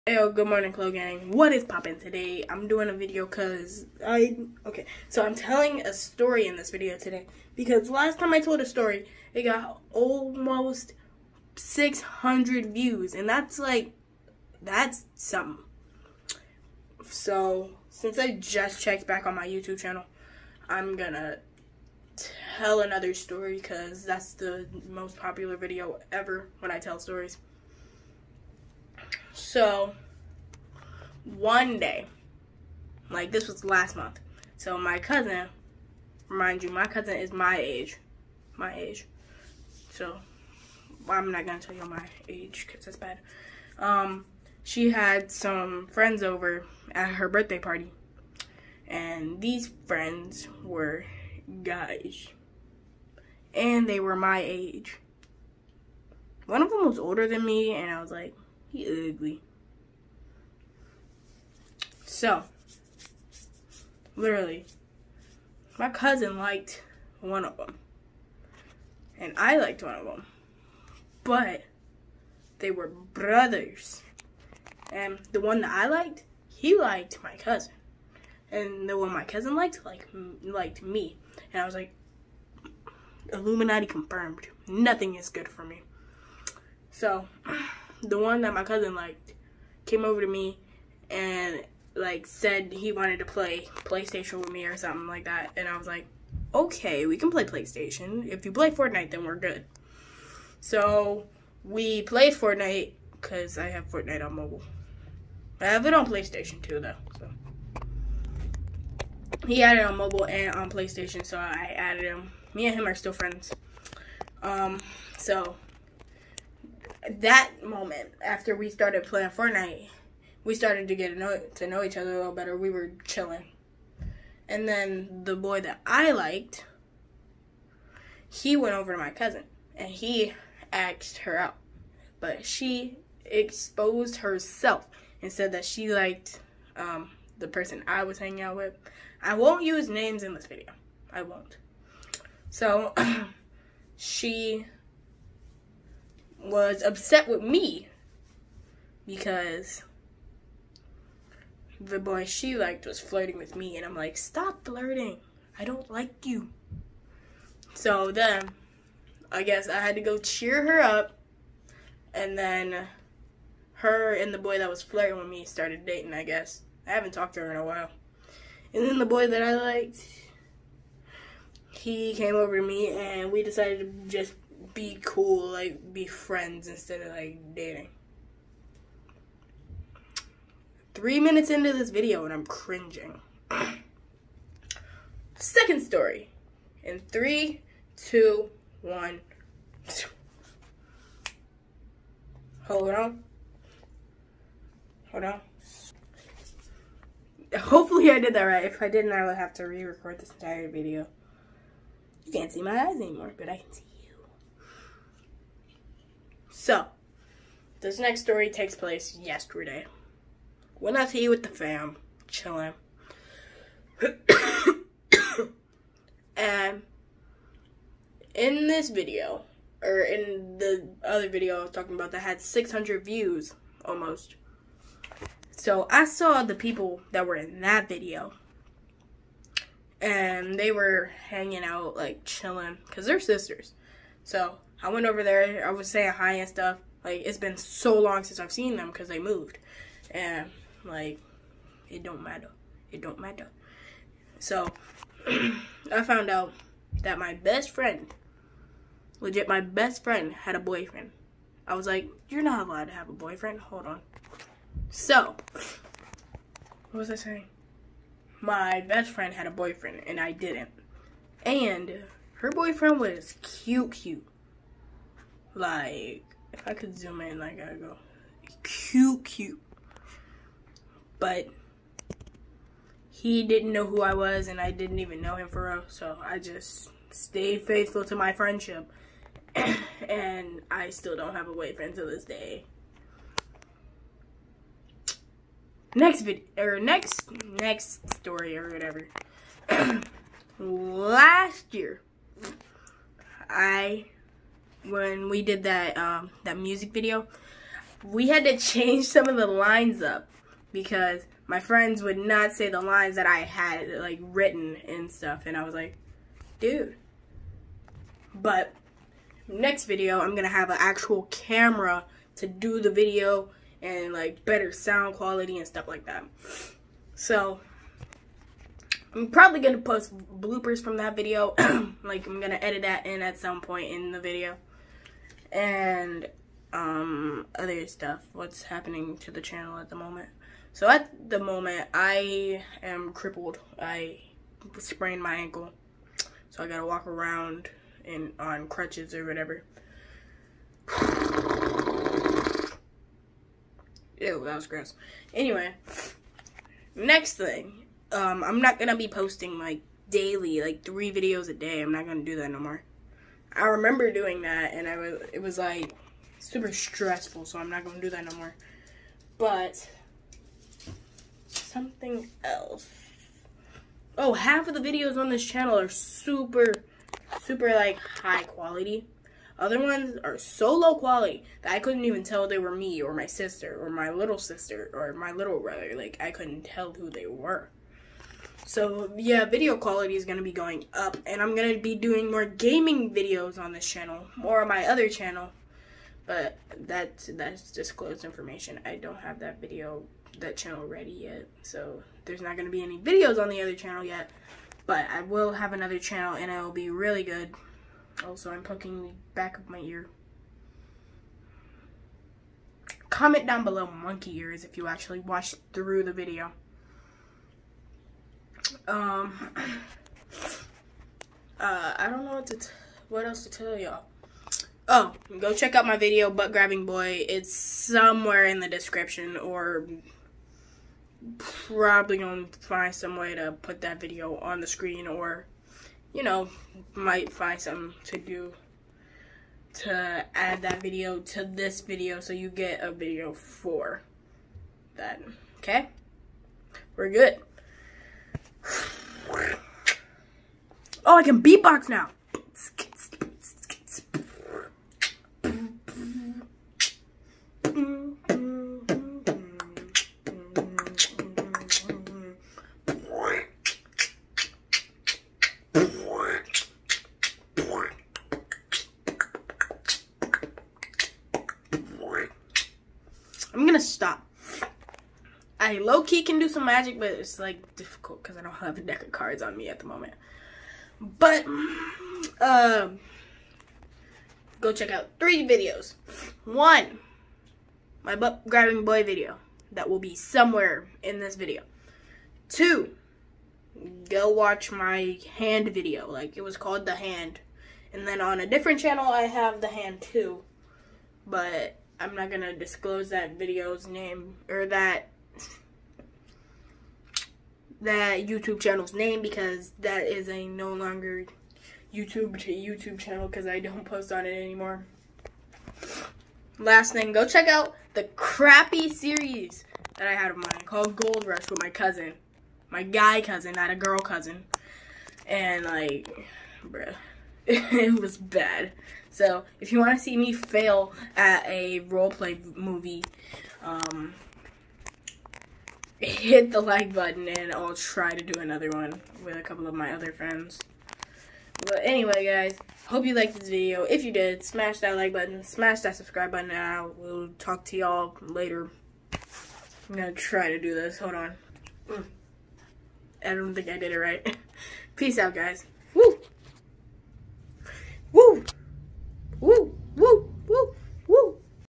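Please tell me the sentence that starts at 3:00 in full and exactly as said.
Three minutes into this video and I'm cringing.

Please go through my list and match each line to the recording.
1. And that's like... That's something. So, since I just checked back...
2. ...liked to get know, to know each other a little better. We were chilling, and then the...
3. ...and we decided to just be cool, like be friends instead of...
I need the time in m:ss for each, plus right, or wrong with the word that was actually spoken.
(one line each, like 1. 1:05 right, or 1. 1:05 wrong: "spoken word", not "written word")
1. 0:13 right
2. 2:00 wrong: "started", not "liked"
3. 2:52 right.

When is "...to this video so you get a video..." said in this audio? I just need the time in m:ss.
7:11.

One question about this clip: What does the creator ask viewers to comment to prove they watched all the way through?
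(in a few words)
monkey ears.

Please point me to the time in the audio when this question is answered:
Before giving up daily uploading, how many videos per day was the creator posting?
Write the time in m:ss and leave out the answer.
5:50.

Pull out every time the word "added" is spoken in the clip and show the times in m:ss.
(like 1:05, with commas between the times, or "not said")
1:51.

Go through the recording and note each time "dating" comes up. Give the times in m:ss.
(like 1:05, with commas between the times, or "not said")
2:45, 2:57.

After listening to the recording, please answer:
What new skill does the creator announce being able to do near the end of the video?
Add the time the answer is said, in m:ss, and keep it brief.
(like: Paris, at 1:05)
beatbox, at 7:21.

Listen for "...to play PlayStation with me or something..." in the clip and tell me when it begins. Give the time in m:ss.
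1:33.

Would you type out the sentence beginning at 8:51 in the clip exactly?
But anyway, guys, hope you liked this video.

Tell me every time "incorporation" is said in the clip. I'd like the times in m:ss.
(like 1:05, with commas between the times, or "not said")
not said.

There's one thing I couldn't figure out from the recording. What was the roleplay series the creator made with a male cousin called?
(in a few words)
Gold Rush.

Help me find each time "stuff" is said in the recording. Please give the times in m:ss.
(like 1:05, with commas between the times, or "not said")
3:56, 5:05, 5:15, 5:27.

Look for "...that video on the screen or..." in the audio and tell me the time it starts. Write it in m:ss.
7:03.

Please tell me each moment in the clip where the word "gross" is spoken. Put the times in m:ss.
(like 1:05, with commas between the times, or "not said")
5:44.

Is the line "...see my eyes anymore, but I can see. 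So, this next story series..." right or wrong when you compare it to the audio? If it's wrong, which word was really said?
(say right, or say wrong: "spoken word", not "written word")
wrong: "takes", not "series".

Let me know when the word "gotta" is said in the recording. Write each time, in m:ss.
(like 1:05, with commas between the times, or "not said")
4:27, 5:36.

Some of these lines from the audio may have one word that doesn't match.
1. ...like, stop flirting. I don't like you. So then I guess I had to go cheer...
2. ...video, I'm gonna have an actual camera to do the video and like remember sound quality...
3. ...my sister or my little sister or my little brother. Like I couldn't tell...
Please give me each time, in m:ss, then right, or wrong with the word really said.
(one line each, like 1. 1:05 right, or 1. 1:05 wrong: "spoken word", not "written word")
1. 2:33 right
2. 5:09 wrong: "better", not "remember"
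3. 6:13 right.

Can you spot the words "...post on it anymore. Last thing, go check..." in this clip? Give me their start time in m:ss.
8:23.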